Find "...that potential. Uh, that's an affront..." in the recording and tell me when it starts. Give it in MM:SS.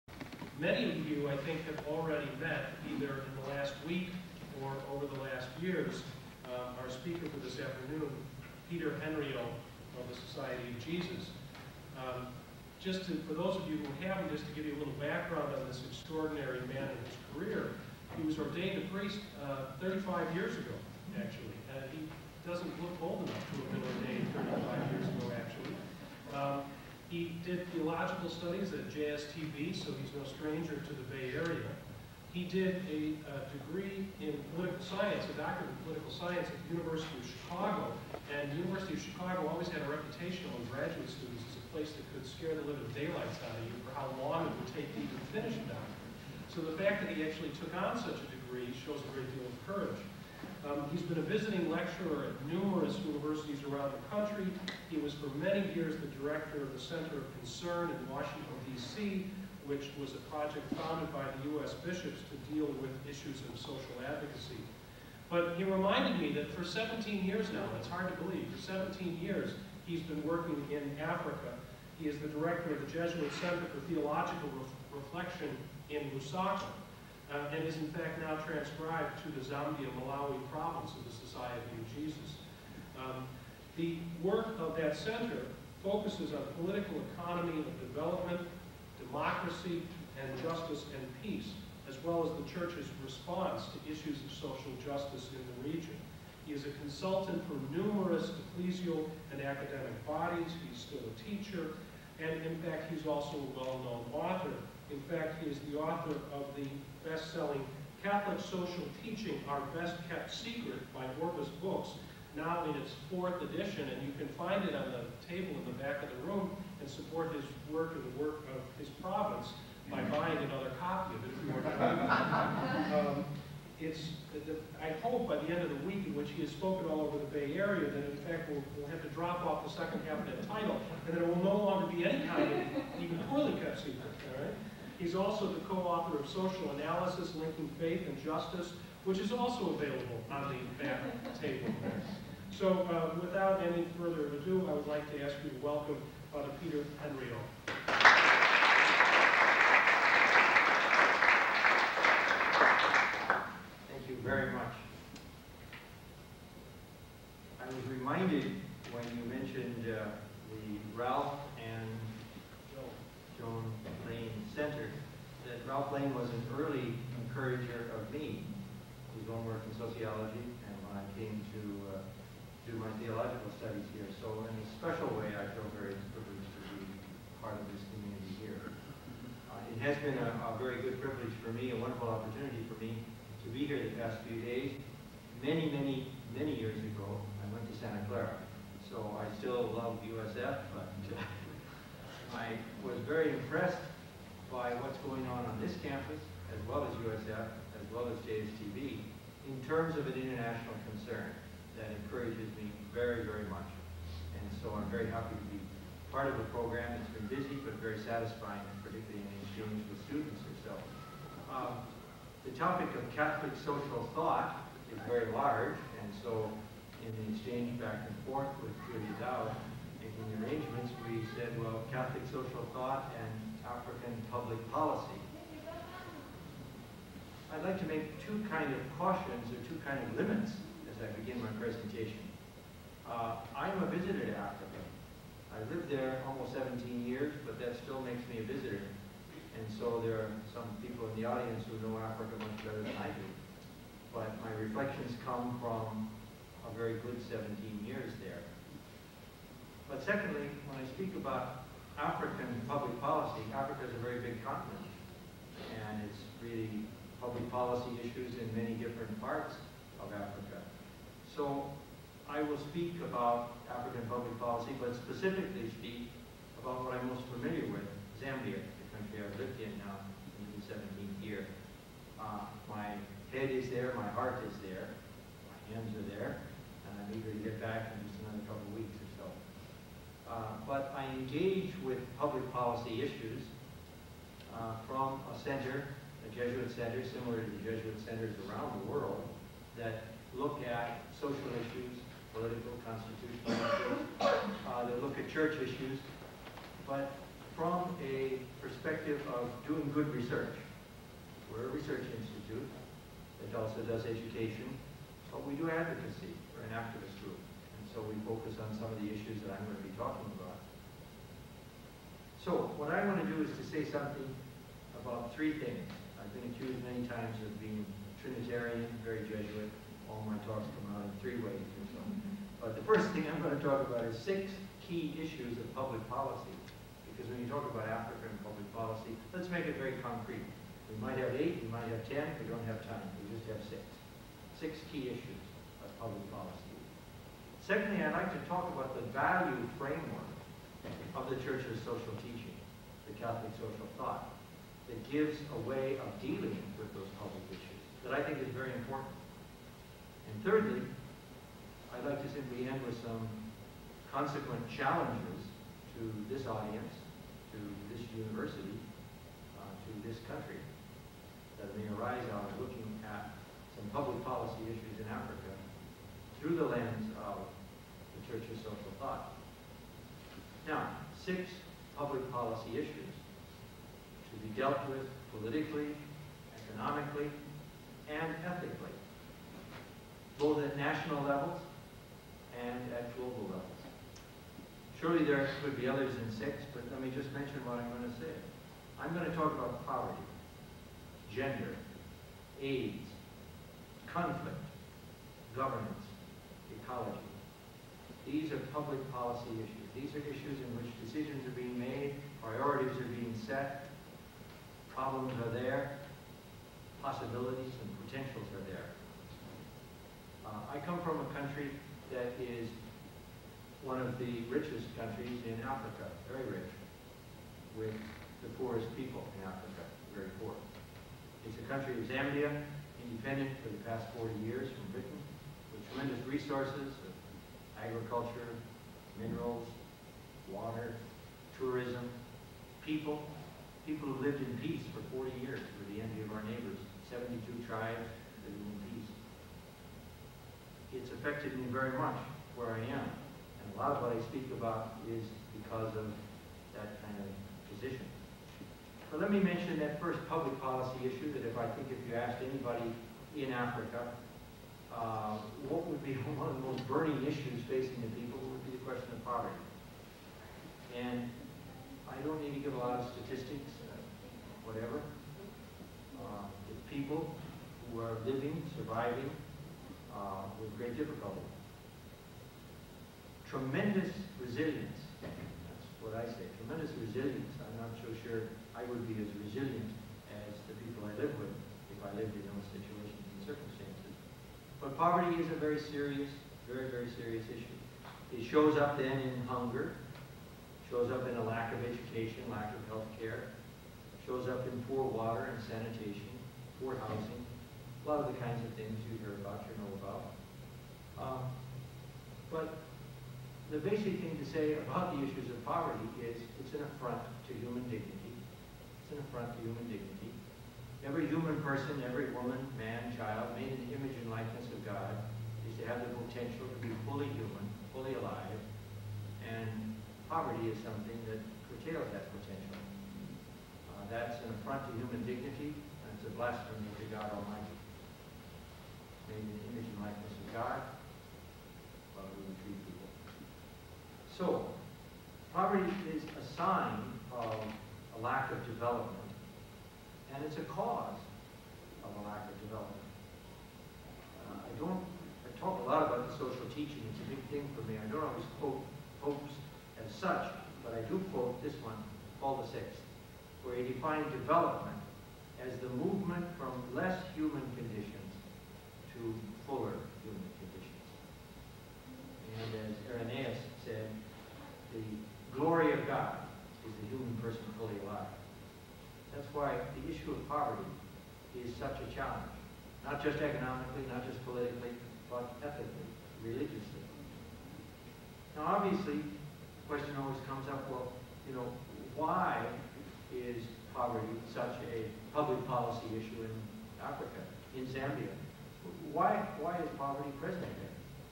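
08:42.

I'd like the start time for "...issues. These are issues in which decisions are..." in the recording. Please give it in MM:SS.
06:39.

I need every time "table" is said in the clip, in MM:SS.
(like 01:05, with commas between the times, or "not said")
01:55, 02:21.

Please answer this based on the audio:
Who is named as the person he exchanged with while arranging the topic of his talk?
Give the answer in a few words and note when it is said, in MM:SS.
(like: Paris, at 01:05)
Julia Dow, at 03:38.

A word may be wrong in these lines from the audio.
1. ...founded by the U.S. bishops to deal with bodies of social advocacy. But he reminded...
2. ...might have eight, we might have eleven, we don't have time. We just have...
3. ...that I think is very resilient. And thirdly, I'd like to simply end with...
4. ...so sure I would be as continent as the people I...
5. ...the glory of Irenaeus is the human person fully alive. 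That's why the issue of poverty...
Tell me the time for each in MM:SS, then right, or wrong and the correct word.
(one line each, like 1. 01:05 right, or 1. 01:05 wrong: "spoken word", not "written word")
1. 01:00 wrong: "issues", not "bodies"
2. 05:31 wrong: "ten", not "eleven"
3. 05:48 wrong: "important", not "resilient"
4. 07:58 wrong: "resilient", not "continent"
5. 09:24 wrong: "God", not "Irenaeus".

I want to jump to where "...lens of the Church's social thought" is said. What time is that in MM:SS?
06:06.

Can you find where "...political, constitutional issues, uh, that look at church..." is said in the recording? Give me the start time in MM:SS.
04:52.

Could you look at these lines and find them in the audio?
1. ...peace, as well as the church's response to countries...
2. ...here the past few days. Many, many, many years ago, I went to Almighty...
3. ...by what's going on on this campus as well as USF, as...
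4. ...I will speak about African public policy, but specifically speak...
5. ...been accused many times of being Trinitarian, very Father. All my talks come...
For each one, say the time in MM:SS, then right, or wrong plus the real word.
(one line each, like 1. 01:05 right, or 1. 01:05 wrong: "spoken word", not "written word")
1. 01:31 wrong: "issues", not "countries"
2. 03:03 wrong: "Santa", not "Almighty"
3. 03:14 right
4. 04:22 right
5. 05:16 wrong: "Jesuit", not "Father".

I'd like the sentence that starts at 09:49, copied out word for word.
Why, why is poverty present there?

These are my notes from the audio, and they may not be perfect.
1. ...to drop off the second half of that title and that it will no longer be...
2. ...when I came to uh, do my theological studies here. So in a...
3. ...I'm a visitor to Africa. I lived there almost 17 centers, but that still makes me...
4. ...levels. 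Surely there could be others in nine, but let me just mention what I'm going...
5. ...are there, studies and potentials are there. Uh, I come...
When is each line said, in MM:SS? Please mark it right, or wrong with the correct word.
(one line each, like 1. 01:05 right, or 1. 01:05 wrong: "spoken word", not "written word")
1. 02:09 right
2. 02:50 right
3. 03:53 wrong: "years", not "centers"
4. 06:23 wrong: "six", not "nine"
5. 06:45 wrong: "possibilities", not "studies".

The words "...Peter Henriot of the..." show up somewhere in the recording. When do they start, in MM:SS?
00:08.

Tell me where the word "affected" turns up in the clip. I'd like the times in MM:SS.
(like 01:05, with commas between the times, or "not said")
07:21.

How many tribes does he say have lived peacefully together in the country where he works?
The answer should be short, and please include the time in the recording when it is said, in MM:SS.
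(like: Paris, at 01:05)
72, at 07:17.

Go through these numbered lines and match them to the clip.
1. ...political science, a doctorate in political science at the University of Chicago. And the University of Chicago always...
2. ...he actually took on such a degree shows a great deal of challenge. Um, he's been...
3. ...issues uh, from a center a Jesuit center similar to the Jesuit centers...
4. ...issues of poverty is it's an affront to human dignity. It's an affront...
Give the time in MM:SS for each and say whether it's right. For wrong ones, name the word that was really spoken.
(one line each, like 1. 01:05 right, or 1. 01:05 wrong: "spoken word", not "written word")
1. 00:34 right
2. 00:47 wrong: "courage", not "challenge"
3. 04:43 right
4. 08:25 right.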